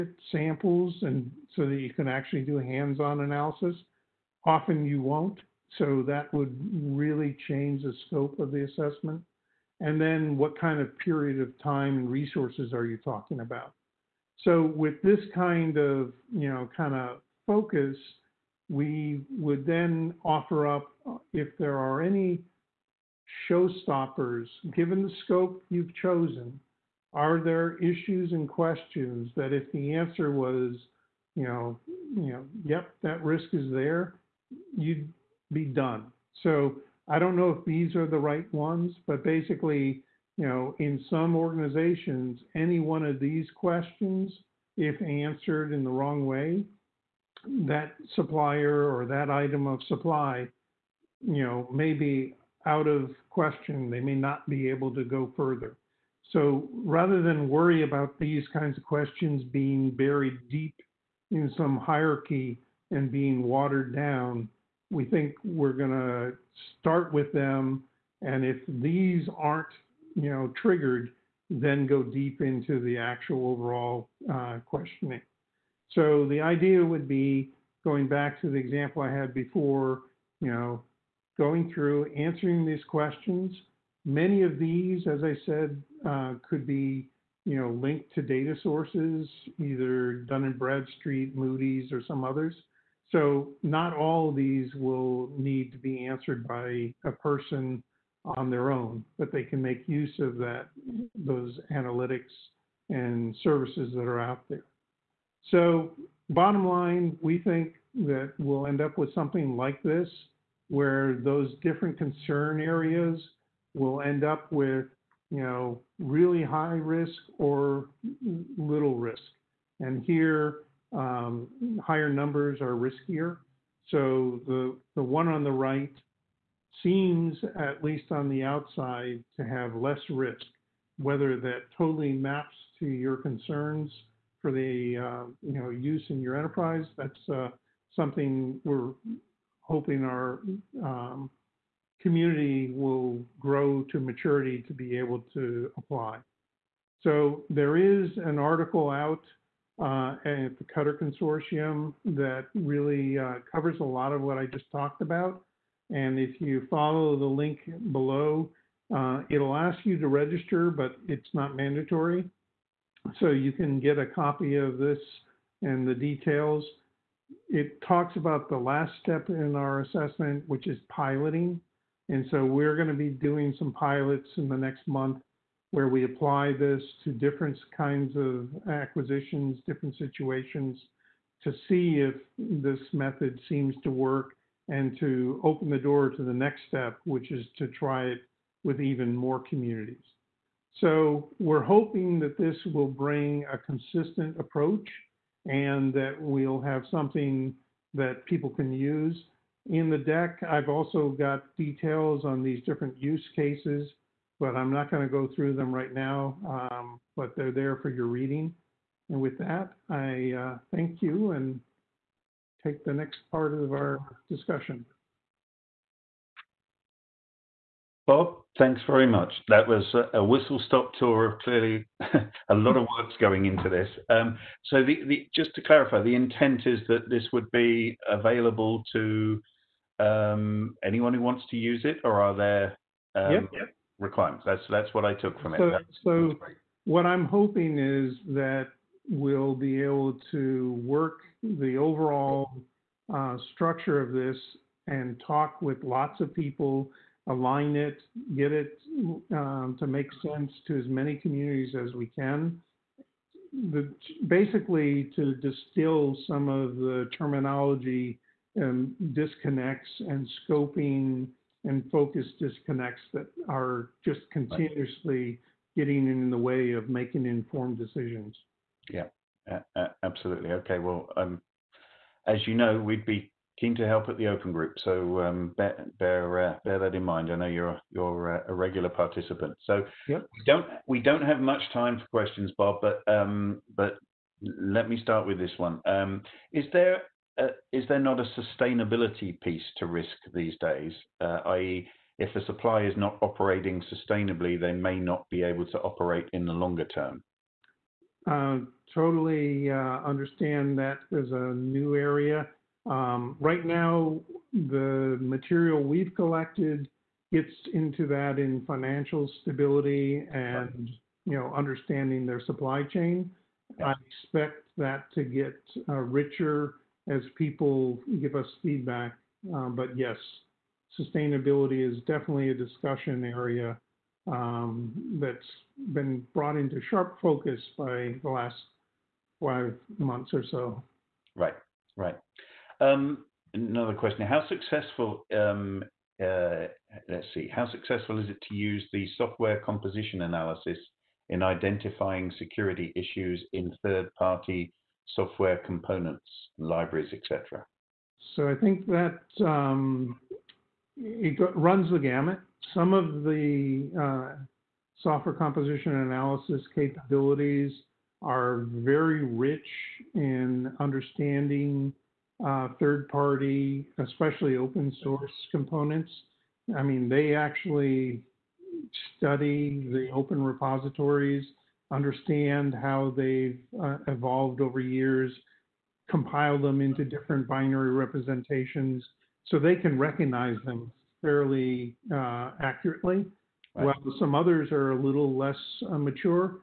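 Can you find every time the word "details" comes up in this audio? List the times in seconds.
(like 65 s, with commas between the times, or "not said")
165 s, 201 s.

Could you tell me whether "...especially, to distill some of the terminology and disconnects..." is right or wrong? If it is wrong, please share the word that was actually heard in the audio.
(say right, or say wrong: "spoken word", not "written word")
wrong: "basically", not "especially".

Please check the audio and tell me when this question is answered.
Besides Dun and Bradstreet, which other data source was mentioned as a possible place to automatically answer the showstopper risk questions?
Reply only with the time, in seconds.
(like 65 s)
91 s.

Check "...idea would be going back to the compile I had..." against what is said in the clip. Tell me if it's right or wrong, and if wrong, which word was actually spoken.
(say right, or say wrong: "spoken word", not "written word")
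wrong: "example", not "compile".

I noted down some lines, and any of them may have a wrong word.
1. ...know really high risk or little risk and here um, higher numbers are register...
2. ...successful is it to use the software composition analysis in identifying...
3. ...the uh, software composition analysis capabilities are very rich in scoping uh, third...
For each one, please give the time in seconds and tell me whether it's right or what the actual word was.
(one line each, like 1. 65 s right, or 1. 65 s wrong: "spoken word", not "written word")
1. 115 s wrong: "riskier", not "register"
2. 337 s right
3. 353 s wrong: "understanding", not "scoping".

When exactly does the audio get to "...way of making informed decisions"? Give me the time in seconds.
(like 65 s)
266 s.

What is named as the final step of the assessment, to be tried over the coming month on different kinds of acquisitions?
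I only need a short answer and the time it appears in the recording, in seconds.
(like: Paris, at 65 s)
Piloting, at 170 s.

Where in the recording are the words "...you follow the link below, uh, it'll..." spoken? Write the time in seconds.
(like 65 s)
156 s.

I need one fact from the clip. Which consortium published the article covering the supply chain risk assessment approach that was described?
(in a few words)
Cutter Consortium.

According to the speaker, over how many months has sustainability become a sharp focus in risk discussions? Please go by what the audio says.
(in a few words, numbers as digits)
5.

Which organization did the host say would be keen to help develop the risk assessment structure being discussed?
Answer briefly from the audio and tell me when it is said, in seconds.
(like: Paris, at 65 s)
The Open Group, at 274 s.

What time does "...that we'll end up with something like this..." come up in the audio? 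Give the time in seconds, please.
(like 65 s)
107 s.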